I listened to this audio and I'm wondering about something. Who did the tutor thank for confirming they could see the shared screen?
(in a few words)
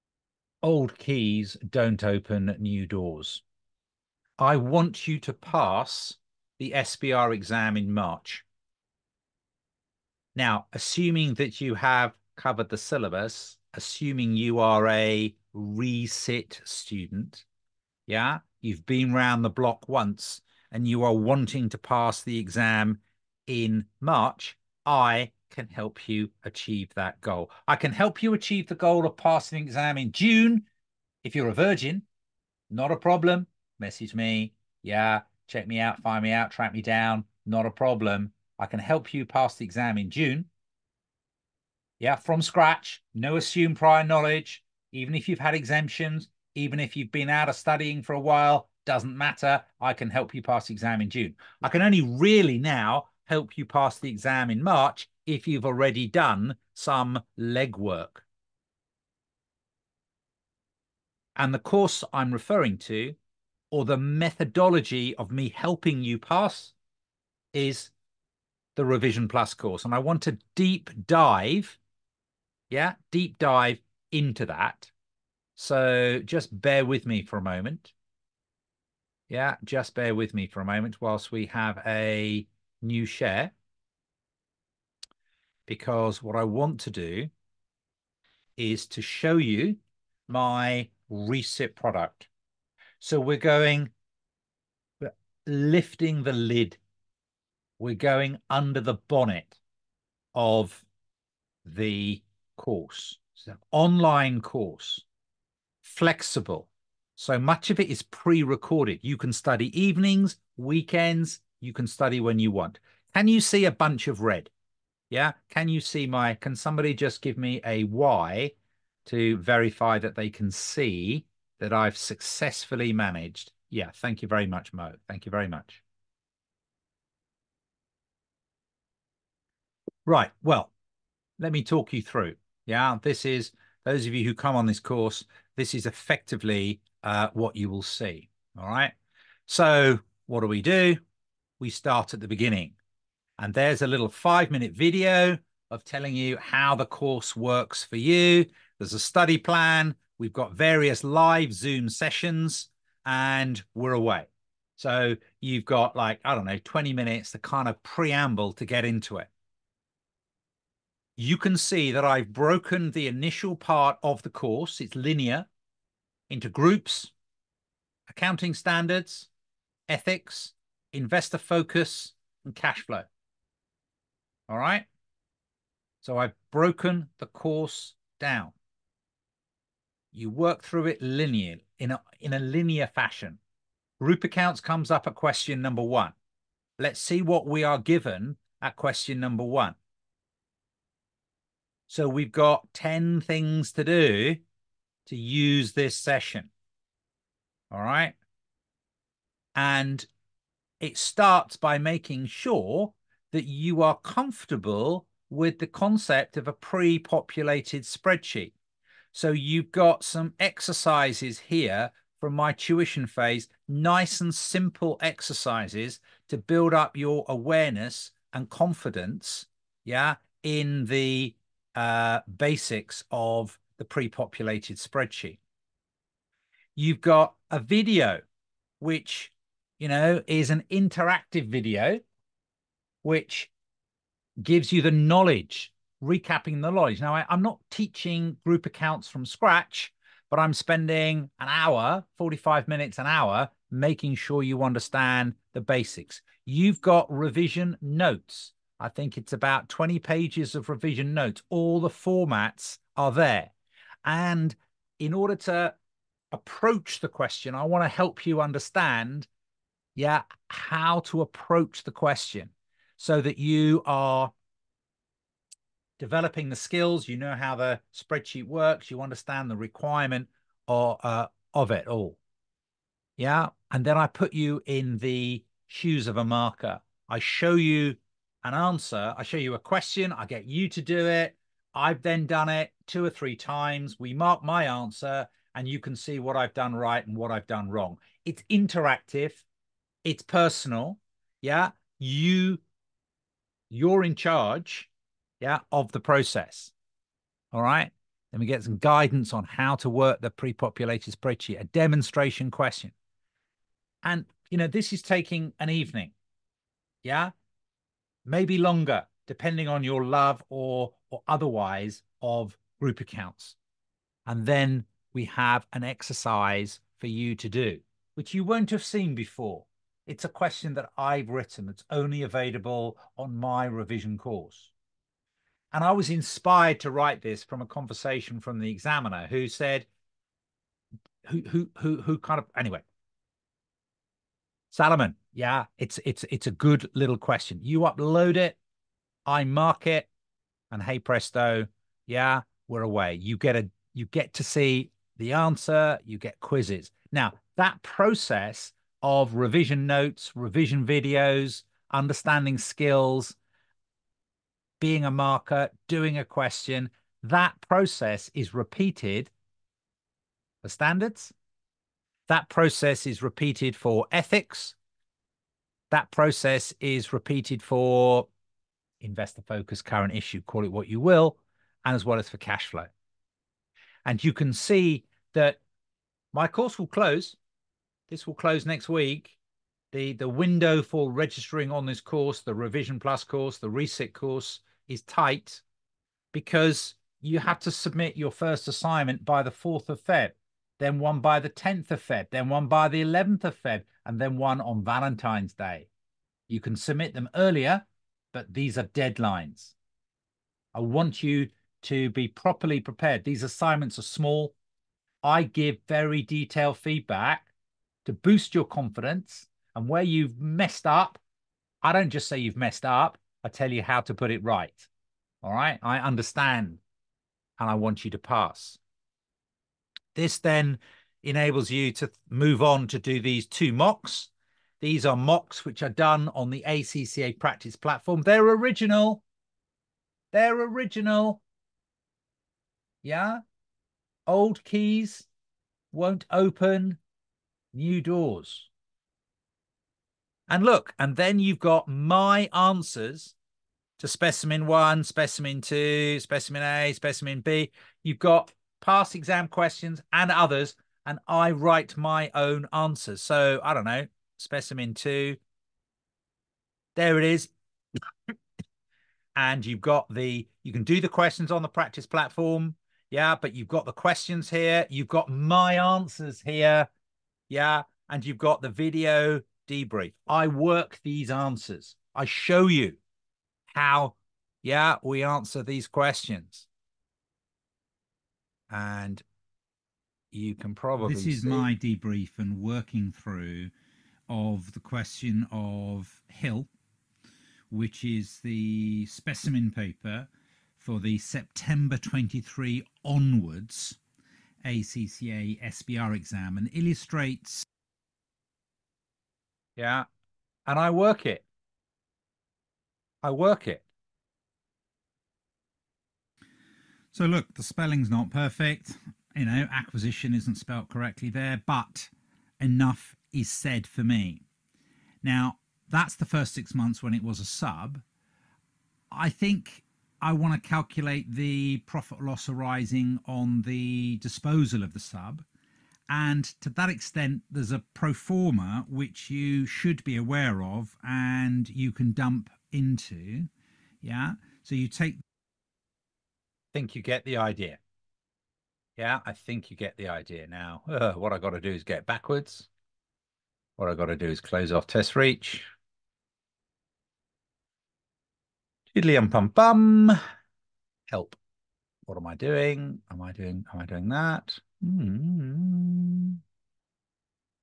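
Mo.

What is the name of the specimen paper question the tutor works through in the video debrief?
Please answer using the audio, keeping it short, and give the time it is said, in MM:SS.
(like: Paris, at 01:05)
Hill, at 08:06.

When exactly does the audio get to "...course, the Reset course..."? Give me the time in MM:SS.
06:23.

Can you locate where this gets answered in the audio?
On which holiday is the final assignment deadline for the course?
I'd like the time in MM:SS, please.
06:34.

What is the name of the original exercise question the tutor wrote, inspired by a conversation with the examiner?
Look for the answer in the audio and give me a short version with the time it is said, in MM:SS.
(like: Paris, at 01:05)
Salomon, at 05:34.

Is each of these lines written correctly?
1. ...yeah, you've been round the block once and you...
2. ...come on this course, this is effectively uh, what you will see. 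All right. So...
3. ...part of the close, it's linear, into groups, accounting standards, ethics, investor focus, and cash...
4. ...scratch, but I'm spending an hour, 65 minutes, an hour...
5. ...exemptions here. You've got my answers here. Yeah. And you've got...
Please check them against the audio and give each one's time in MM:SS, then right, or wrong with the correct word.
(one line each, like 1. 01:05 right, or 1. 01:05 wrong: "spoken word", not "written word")
1. 00:18 right
2. 02:14 right
3. 02:43 wrong: "course", not "close"
4. 03:59 wrong: "45", not "65"
5. 07:43 wrong: "questions", not "exemptions".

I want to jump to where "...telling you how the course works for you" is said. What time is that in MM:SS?
02:25.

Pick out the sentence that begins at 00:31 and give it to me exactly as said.
If you're a virgin, not a problem.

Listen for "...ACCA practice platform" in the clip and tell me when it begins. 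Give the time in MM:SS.
07:06.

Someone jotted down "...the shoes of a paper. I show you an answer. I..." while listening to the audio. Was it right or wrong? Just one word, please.
wrong.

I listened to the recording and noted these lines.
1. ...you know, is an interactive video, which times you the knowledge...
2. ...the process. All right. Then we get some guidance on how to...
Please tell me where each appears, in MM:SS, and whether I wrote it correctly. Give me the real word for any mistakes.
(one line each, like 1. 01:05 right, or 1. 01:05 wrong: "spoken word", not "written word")
1. 03:49 wrong: "gives", not "times"
2. 04:55 right.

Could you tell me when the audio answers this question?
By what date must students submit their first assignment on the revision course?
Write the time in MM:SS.
06:29.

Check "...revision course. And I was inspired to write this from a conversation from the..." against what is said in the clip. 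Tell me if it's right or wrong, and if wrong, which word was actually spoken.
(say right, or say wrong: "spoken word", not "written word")
right.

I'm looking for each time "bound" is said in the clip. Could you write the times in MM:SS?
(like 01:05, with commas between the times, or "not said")
not said.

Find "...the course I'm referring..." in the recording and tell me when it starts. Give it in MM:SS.
01:01.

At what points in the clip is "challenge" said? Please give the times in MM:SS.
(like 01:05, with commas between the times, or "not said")
not said.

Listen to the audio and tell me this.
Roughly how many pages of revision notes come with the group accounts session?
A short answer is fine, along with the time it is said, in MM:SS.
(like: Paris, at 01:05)
20, at 04:09.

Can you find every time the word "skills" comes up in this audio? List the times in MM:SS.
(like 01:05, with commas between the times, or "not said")
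04:26, 05:52.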